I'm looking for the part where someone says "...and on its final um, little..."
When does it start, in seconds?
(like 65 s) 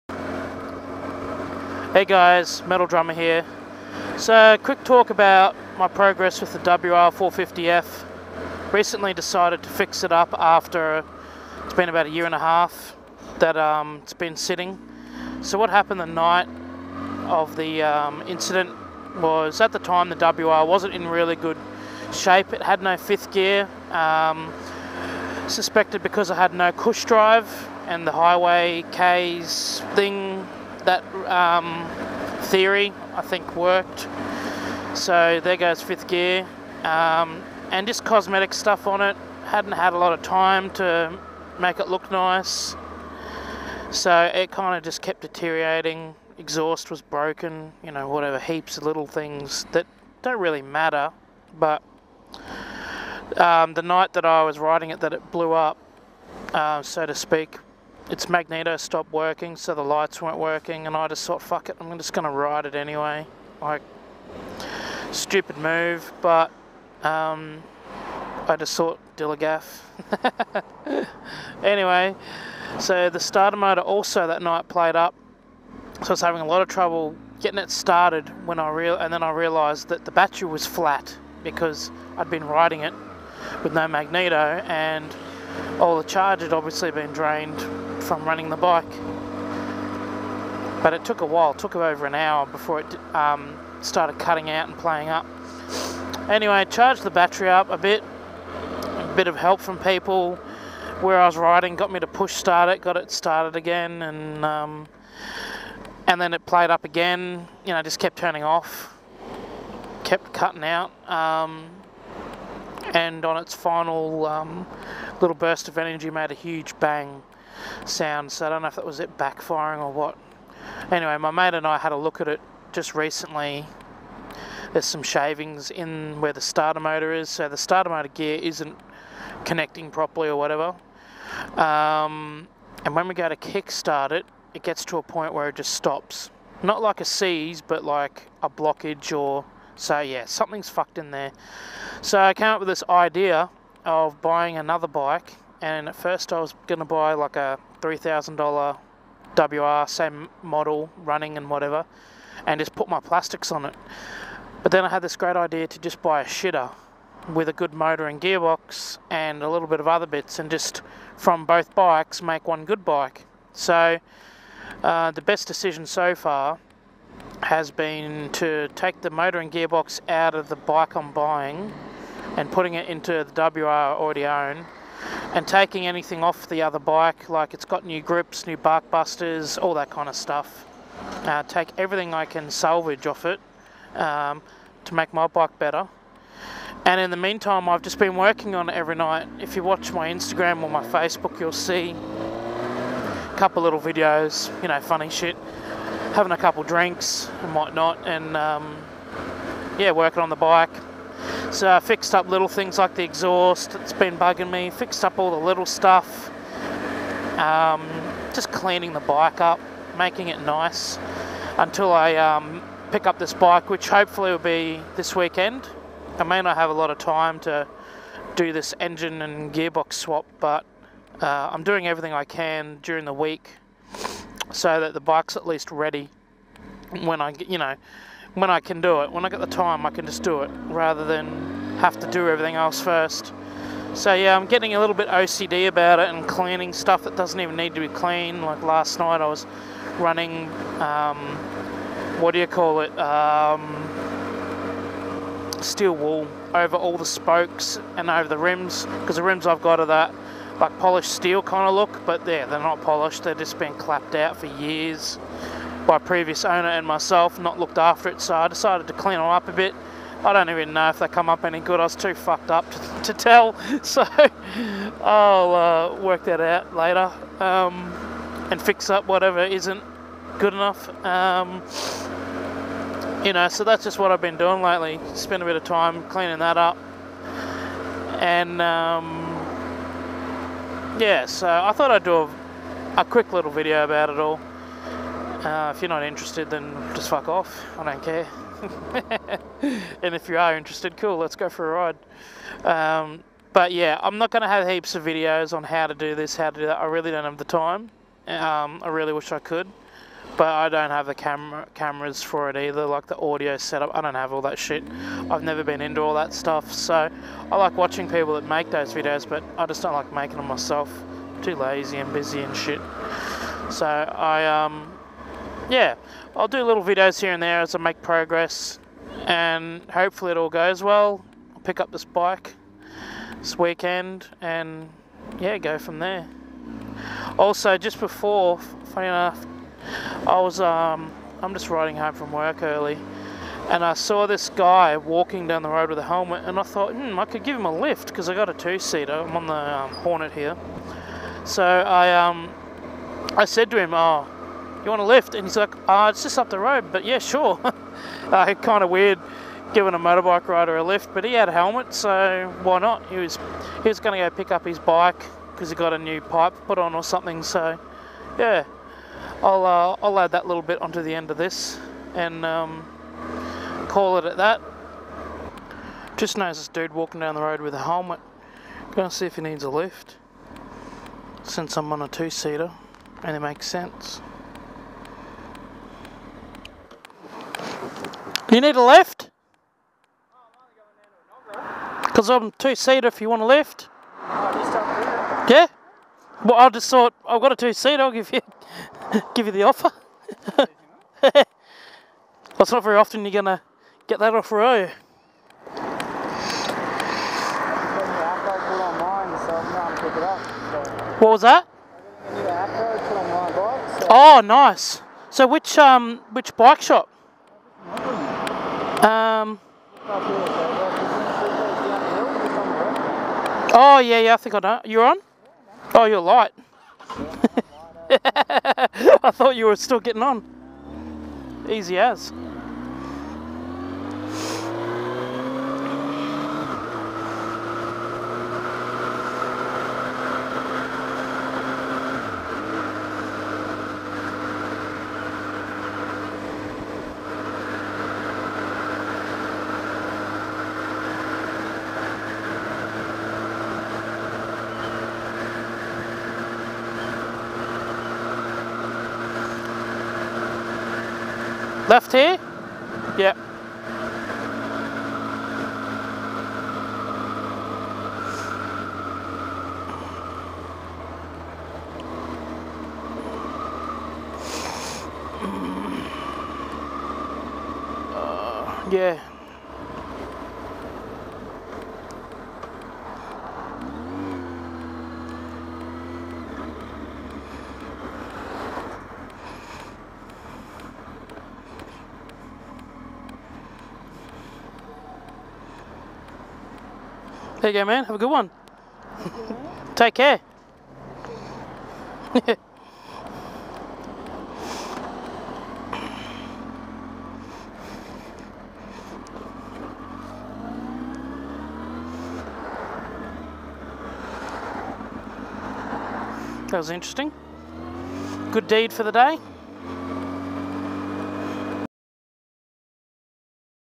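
112 s.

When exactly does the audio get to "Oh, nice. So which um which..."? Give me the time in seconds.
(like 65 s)
404 s.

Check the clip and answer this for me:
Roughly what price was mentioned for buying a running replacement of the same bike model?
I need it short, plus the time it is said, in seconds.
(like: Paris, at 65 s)
$3,000, at 147 s.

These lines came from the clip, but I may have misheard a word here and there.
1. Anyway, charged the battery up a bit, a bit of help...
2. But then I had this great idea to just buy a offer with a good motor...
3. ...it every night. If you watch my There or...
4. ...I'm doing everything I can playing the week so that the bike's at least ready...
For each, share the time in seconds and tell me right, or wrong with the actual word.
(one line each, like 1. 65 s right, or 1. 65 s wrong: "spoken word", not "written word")
1. 96 s right
2. 154 s wrong: "shitter", not "offer"
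3. 188 s wrong: "Instagram", not "There"
4. 221 s wrong: "during", not "playing".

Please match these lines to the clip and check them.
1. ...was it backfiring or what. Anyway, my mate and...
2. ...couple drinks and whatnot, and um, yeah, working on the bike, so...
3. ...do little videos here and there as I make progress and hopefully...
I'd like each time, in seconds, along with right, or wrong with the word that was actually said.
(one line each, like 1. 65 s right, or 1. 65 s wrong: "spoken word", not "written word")
1. 118 s right
2. 196 s right
3. 316 s right.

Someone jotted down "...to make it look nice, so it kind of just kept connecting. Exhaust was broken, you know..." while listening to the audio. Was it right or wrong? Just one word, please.
wrong.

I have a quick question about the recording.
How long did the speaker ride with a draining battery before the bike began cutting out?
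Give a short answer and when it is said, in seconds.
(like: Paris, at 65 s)
over an hour, at 91 s.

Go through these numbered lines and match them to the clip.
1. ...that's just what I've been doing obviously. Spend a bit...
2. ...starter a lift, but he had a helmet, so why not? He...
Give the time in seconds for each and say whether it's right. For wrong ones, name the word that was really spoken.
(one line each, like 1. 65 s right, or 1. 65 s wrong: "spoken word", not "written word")
1. 273 s wrong: "lately", not "obviously"
2. 350 s wrong: "rider", not "starter".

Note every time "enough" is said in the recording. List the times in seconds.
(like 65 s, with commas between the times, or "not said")
270 s, 329 s.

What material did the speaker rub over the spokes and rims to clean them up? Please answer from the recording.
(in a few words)
steel wool.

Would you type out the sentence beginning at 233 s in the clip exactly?
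So yeah, I'm getting a little bit OCD about it and cleaning stuff that doesn't even need to be clean.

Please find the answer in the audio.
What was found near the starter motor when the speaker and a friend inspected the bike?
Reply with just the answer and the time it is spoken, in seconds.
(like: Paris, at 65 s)
shavings, at 125 s.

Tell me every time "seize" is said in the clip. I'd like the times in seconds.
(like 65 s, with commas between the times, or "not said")
137 s.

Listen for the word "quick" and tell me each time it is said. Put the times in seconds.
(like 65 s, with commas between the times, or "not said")
4 s, 283 s.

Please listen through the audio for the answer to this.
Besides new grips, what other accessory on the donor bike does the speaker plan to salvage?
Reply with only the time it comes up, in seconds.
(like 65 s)
178 s.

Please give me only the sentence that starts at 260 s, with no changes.
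I don't even know if they come up any good.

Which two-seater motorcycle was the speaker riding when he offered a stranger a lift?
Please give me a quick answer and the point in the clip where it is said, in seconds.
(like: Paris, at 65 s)
Hornet, at 339 s.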